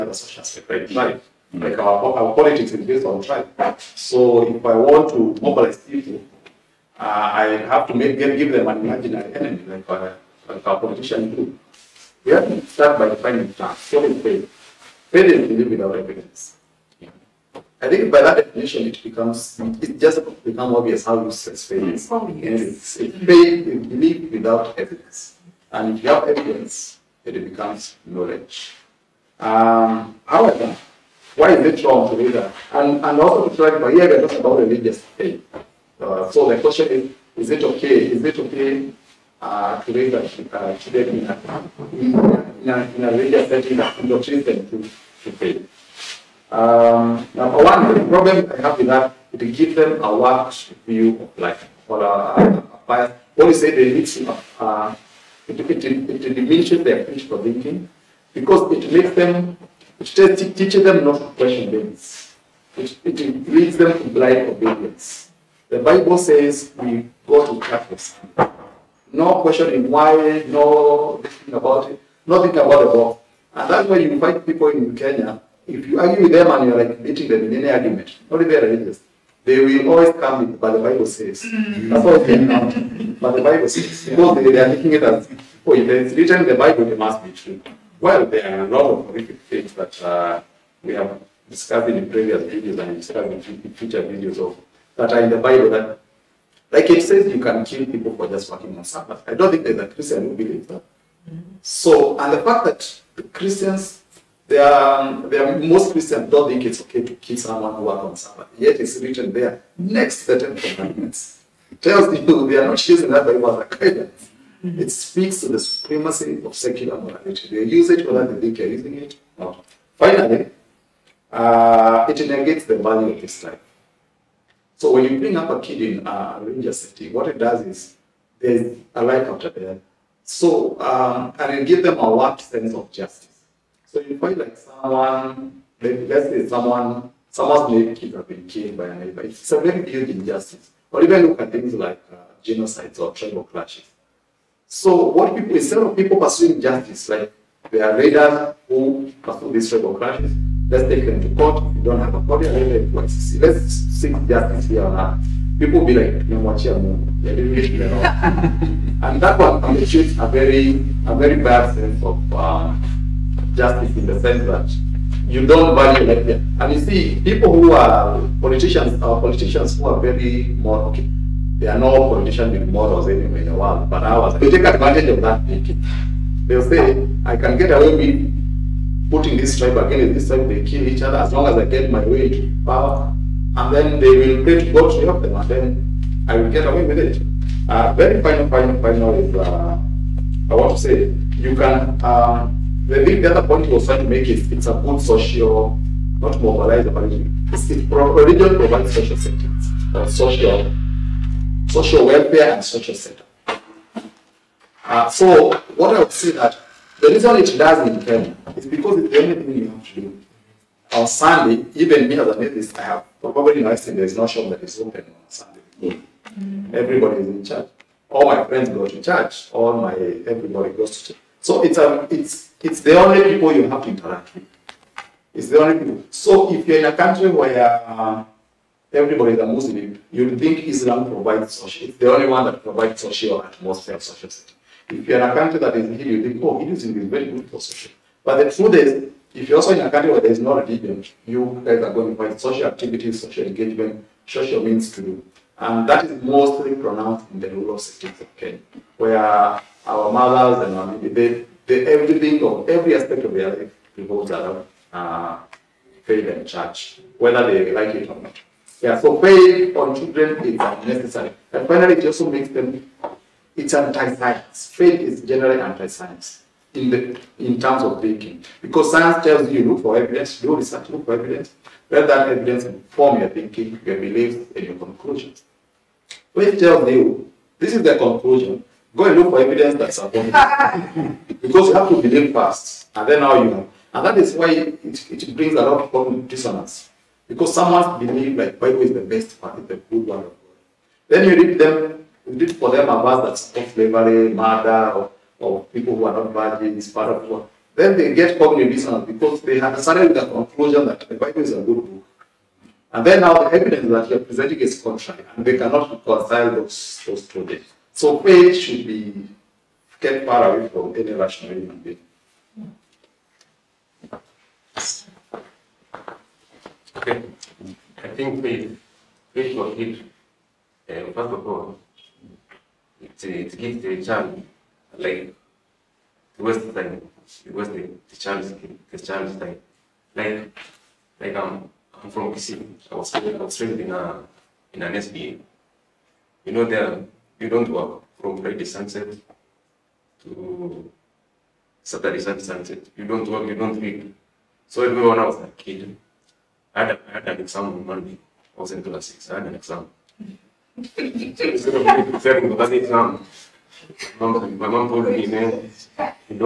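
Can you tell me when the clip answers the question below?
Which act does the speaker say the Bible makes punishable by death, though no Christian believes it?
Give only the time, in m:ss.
1:38.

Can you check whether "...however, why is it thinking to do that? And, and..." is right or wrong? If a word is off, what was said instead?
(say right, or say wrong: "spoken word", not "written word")
wrong: "wrong", not "thinking".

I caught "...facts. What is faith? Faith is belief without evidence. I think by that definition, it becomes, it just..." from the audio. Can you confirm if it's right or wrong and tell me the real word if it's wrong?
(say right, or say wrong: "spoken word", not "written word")
right.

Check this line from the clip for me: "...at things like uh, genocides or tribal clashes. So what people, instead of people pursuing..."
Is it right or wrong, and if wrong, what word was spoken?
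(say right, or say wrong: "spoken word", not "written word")
right.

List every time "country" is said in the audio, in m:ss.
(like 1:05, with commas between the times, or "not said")
3:46, 3:55, 3:59.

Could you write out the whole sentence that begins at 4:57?
Then they get cognitive dissonance because they have started with the conclusion that the Bible is a good book.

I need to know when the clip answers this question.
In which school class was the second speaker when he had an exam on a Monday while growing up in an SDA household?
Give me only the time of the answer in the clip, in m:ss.
5:48.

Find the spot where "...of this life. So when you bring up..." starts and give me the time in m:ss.
2:03.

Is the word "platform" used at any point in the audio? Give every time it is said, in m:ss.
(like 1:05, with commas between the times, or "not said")
not said.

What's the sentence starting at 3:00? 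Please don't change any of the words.
They kill each other as long as I get my way to power.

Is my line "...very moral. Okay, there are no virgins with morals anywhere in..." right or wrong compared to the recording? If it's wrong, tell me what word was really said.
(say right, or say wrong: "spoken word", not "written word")
wrong: "politicians", not "virgins".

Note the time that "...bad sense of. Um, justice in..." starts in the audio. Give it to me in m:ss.
2:41.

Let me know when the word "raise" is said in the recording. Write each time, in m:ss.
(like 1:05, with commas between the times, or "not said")
0:39.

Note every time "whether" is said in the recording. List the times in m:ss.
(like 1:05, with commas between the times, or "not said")
1:58, 4:17.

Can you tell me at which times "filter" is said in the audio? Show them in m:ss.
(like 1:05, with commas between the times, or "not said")
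not said.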